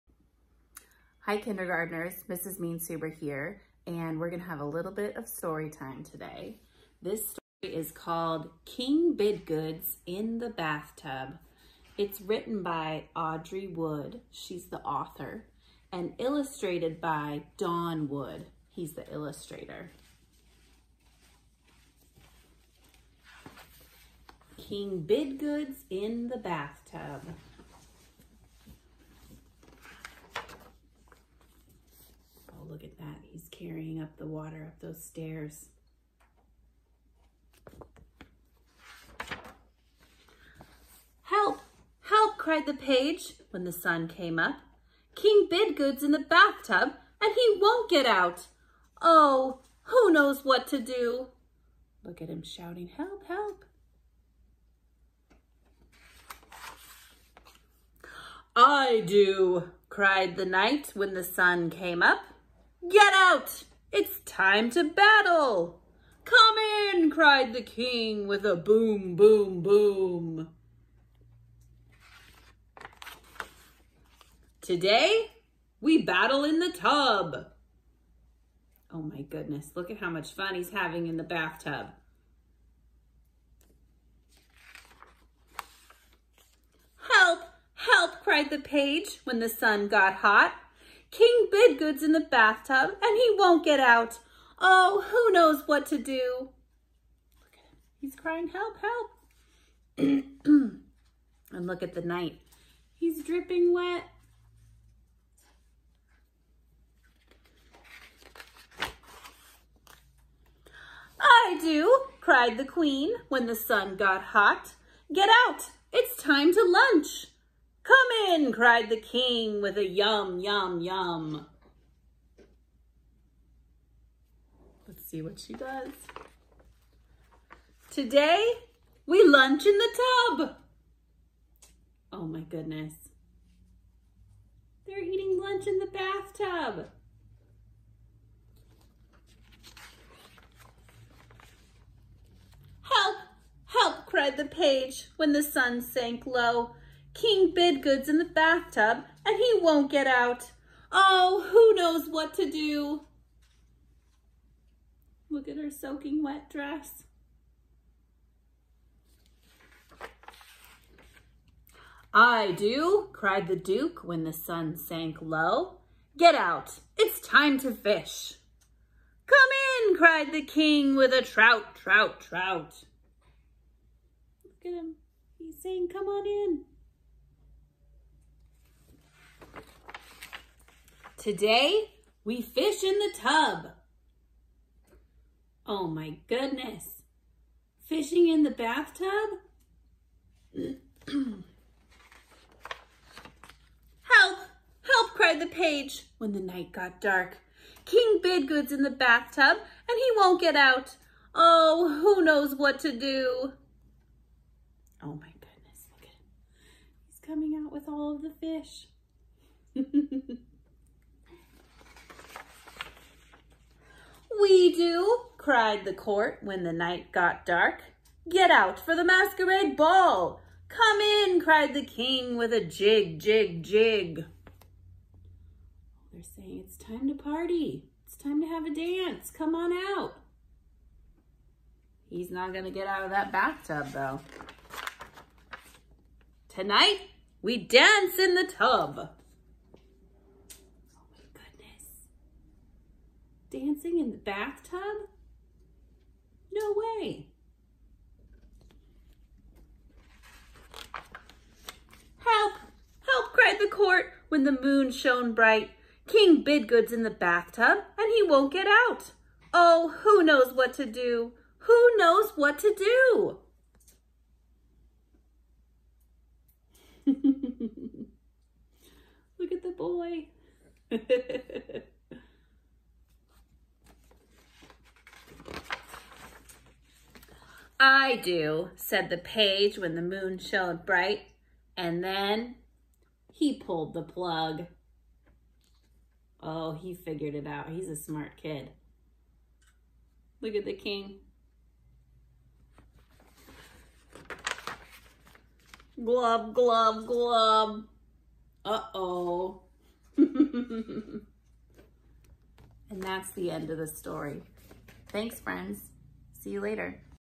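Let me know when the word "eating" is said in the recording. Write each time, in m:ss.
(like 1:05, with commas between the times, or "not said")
2:15.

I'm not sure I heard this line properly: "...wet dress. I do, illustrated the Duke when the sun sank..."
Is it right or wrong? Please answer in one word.
wrong.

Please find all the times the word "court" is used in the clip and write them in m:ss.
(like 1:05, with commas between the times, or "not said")
3:35, 4:13.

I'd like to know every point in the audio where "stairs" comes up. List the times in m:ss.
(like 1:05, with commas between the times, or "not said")
0:35.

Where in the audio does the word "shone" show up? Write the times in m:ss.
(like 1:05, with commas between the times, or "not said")
4:14, 4:40.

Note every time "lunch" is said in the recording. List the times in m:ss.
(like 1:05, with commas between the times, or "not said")
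1:56, 2:09, 2:15.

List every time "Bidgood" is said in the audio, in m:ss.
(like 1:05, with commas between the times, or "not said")
0:09, 0:25, 0:45, 1:31, 2:27, 3:18, 4:16.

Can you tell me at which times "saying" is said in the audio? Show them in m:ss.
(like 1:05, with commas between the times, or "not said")
2:55, 3:46.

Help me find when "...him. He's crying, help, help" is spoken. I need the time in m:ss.
1:37.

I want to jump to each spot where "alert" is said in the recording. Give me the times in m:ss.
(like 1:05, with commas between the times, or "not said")
not said.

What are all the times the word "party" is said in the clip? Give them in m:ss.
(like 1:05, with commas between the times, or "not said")
3:47.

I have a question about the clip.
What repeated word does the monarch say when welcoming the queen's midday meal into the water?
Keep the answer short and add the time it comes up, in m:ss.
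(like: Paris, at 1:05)
yum, yum, yum, at 1:59.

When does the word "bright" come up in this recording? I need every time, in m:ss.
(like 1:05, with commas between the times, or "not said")
4:15, 4:40.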